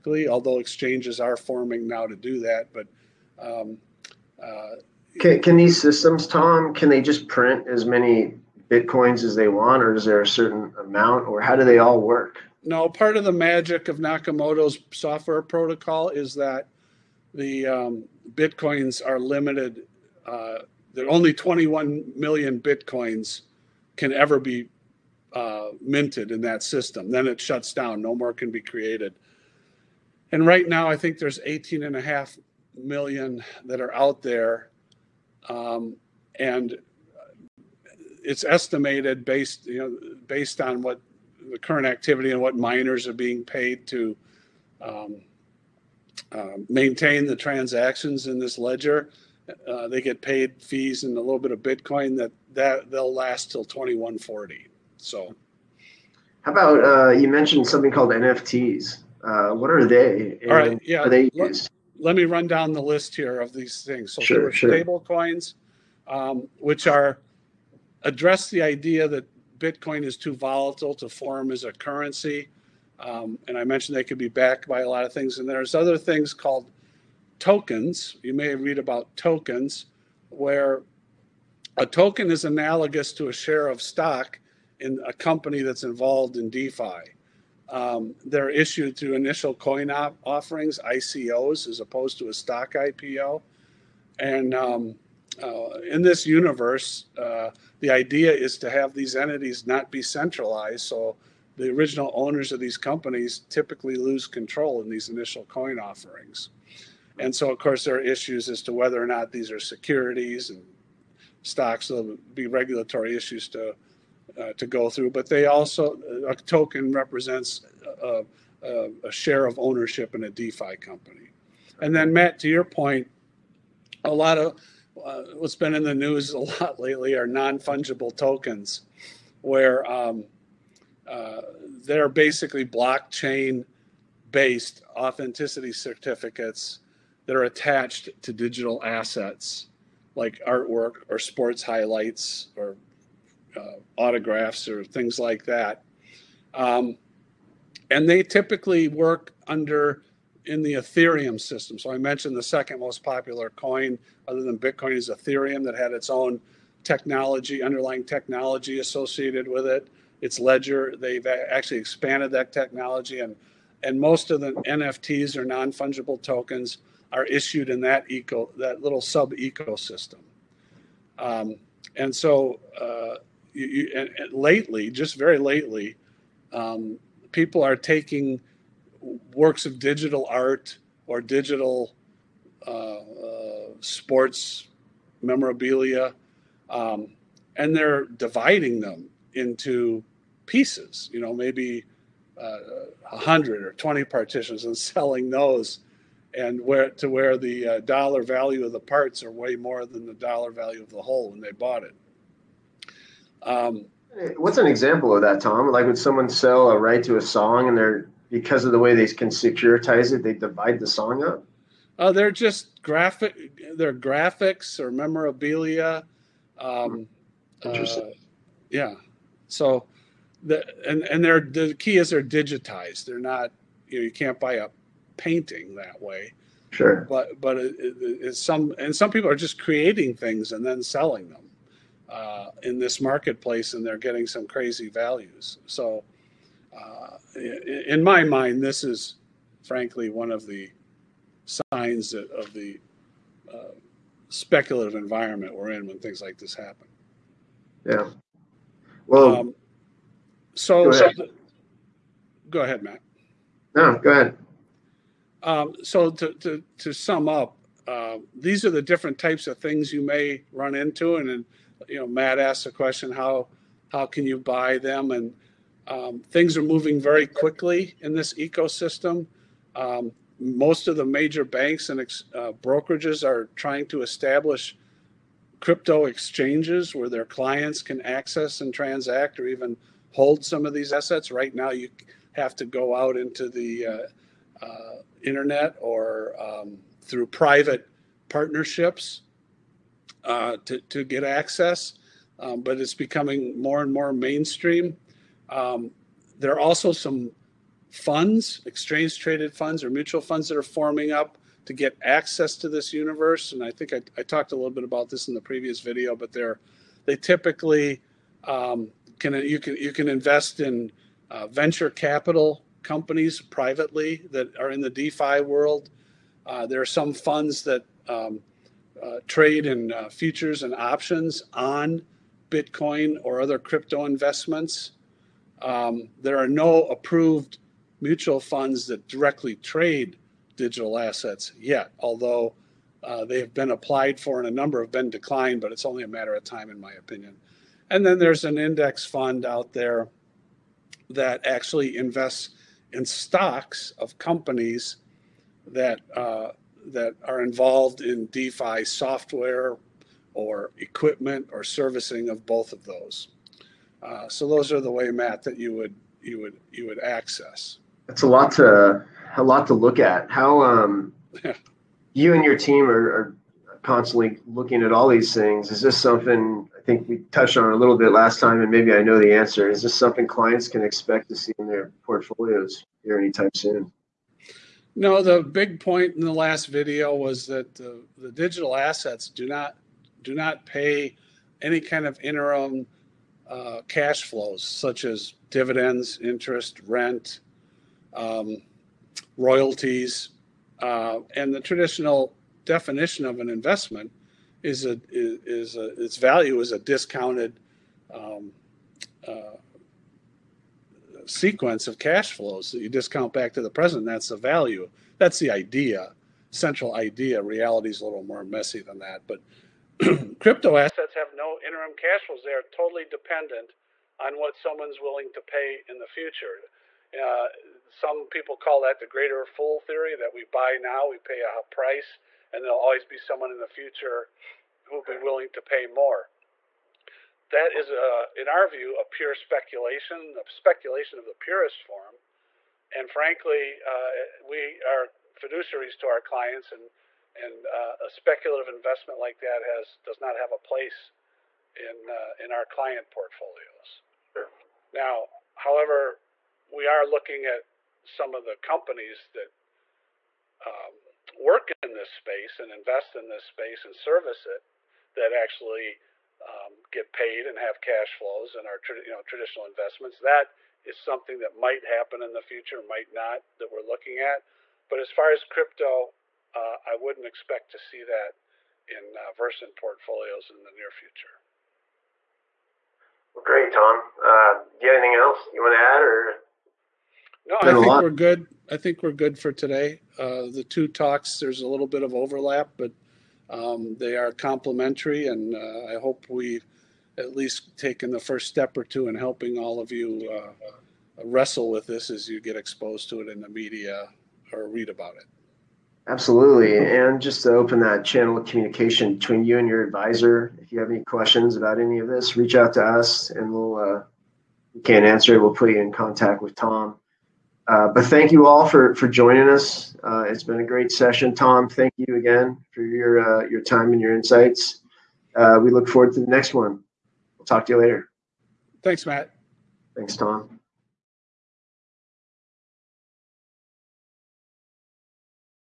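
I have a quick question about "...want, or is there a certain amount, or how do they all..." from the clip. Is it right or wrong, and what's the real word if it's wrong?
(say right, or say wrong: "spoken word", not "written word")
right.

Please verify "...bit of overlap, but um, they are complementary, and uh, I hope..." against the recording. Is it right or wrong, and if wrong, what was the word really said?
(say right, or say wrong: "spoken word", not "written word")
right.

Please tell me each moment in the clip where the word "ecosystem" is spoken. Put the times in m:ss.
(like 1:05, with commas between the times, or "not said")
2:49, 4:28.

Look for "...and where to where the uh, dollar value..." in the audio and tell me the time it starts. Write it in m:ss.
3:16.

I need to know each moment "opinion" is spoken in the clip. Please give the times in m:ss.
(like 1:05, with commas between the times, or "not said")
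5:36.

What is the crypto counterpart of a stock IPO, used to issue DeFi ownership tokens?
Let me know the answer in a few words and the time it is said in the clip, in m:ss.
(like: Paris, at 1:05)
Initial coin offerings, at 1:29.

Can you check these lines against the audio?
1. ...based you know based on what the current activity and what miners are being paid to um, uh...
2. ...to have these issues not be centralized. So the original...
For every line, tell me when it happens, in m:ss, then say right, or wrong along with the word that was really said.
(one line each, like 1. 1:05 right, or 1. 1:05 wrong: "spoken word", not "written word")
1. 0:39 right
2. 1:38 wrong: "entities", not "issues".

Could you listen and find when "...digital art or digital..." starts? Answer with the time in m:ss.
2:59.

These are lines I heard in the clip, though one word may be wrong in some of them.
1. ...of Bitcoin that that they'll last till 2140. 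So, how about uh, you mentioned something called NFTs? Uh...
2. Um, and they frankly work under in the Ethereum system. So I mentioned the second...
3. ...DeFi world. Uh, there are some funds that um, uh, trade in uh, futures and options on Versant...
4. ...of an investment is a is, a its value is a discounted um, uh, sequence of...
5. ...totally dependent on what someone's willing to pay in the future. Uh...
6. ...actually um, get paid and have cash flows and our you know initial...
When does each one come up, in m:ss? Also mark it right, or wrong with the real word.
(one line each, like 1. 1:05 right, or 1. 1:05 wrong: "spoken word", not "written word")
1. 0:51 right
2. 2:26 wrong: "typically", not "frankly"
3. 5:14 wrong: "Bitcoin", not "Versant"
4. 6:33 right
5. 6:52 right
6. 7:35 wrong: "traditional", not "initial".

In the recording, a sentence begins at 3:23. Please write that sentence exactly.
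Um, What's an example of that, Tom?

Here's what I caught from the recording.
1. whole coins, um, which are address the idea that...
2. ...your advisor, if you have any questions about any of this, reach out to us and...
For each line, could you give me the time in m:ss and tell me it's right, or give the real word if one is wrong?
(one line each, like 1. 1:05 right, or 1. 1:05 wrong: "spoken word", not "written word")
1. 1:04 wrong: "stable", not "whole"
2. 8:19 right.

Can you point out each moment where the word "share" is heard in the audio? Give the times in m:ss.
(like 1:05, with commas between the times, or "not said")
1:23, 1:59.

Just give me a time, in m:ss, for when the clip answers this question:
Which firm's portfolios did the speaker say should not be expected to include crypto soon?
7:49.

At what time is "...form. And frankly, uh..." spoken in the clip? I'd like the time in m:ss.
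7:11.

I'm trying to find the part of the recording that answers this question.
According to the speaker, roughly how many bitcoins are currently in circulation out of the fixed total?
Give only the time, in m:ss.
0:31.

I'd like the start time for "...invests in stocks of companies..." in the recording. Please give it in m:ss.
5:41.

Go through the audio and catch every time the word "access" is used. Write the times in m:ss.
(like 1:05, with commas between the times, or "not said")
4:38, 4:51, 5:02, 5:56.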